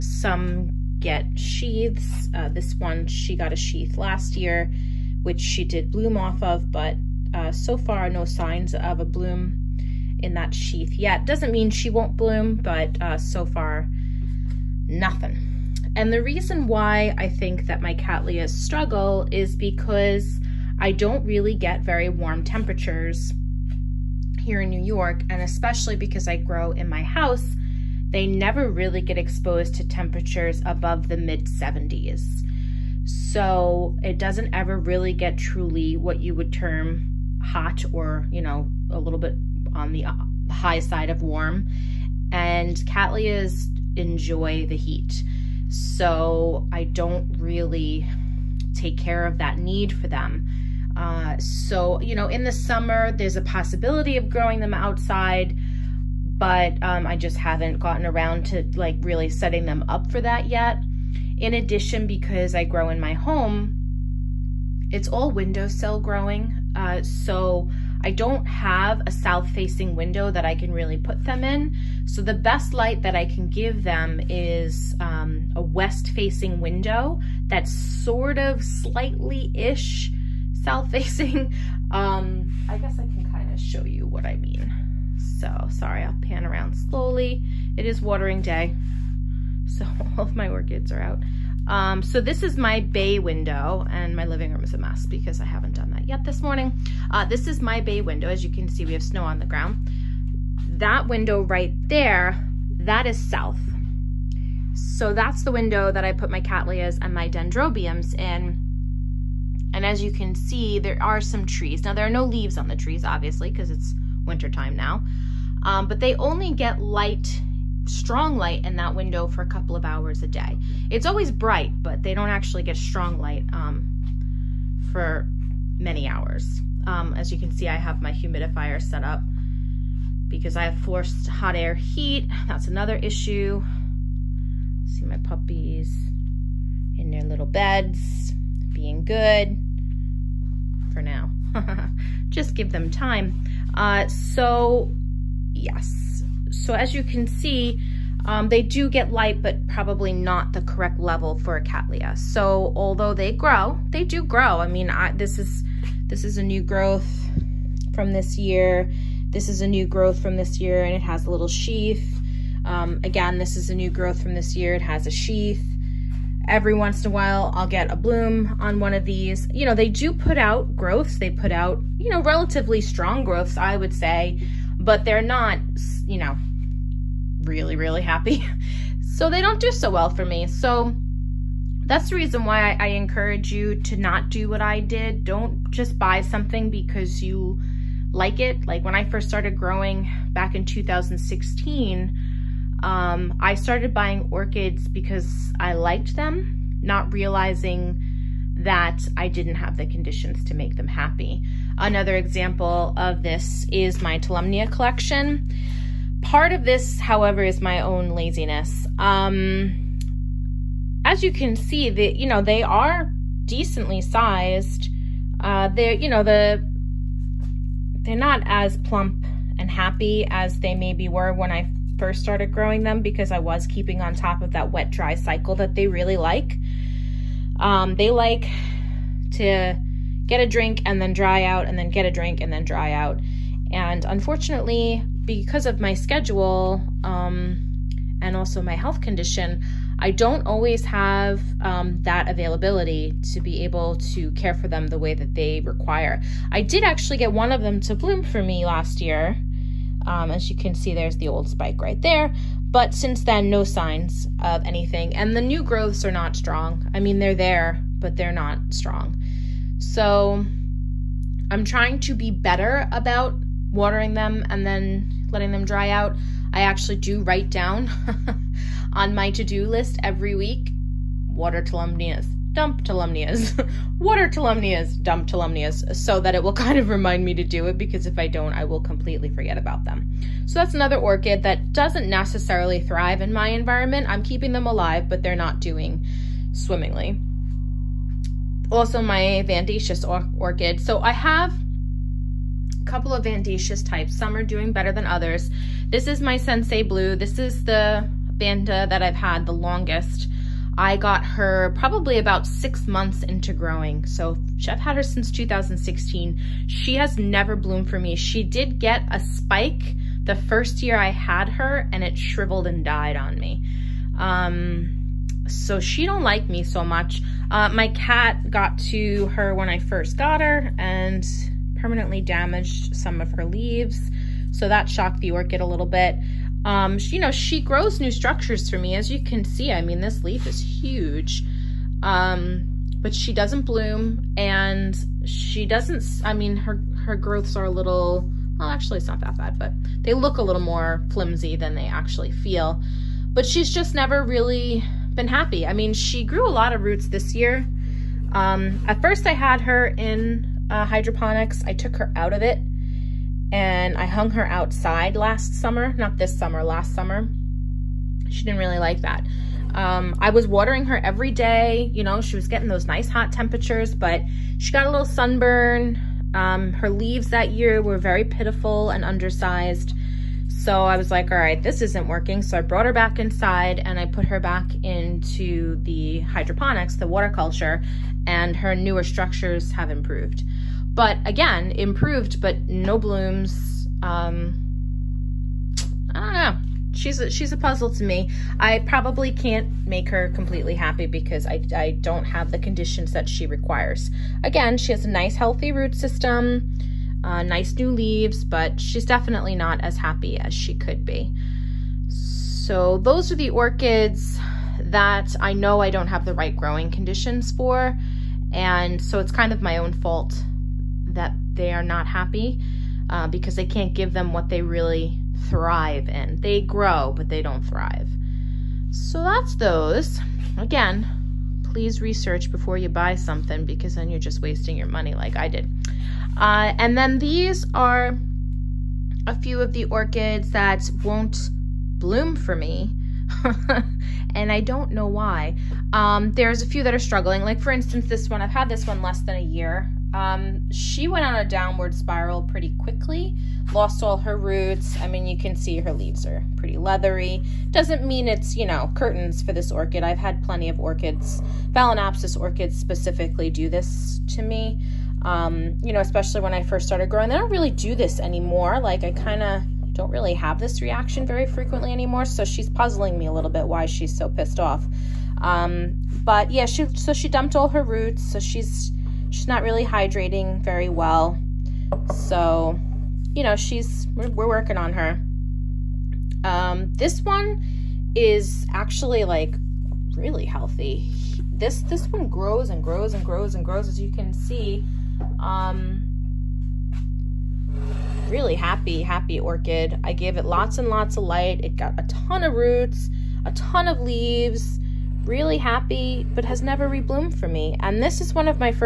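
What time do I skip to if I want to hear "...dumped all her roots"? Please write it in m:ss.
7:47.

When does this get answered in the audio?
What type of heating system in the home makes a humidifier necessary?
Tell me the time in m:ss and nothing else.
2:10.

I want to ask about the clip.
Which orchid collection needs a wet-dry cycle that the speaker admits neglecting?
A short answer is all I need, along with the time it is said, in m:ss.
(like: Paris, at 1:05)
Tolumnia, at 3:24.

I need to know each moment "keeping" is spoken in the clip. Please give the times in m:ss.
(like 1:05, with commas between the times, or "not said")
3:43, 4:44.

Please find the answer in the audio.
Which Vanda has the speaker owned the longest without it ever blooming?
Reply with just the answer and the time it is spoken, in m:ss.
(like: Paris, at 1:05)
Sensei Blue, at 4:56.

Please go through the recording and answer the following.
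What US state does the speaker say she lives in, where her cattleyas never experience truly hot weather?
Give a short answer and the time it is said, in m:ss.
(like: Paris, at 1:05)
New York, at 0:24.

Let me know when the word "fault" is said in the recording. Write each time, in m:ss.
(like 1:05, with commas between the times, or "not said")
6:49.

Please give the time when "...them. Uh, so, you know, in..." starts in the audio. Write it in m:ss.
0:50.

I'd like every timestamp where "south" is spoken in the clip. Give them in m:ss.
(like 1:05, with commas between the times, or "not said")
1:09, 1:20, 1:43.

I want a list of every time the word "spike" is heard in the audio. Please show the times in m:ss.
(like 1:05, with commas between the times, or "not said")
4:11, 5:09.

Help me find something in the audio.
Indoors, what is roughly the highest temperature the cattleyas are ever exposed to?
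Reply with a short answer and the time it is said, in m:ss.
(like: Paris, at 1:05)
mid 70s, at 0:31.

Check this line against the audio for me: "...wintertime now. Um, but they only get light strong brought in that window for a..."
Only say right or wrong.
wrong.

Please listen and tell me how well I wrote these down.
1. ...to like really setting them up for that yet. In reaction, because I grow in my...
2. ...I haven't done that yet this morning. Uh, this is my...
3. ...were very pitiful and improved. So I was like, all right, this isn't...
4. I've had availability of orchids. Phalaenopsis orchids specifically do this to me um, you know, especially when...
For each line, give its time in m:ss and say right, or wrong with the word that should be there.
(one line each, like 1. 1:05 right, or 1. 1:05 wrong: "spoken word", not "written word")
1. 0:58 wrong: "addition", not "reaction"
2. 1:35 right
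3. 6:07 wrong: "undersized", not "improved"
4. 7:30 wrong: "plenty", not "availability".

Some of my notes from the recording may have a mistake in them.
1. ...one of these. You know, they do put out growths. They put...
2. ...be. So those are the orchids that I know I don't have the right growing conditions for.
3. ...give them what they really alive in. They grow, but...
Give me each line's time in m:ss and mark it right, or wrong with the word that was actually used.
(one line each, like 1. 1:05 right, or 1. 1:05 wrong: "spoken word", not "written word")
1. 2:48 right
2. 6:41 right
3. 6:53 wrong: "thrive", not "alive".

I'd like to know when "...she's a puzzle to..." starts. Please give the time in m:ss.
6:27.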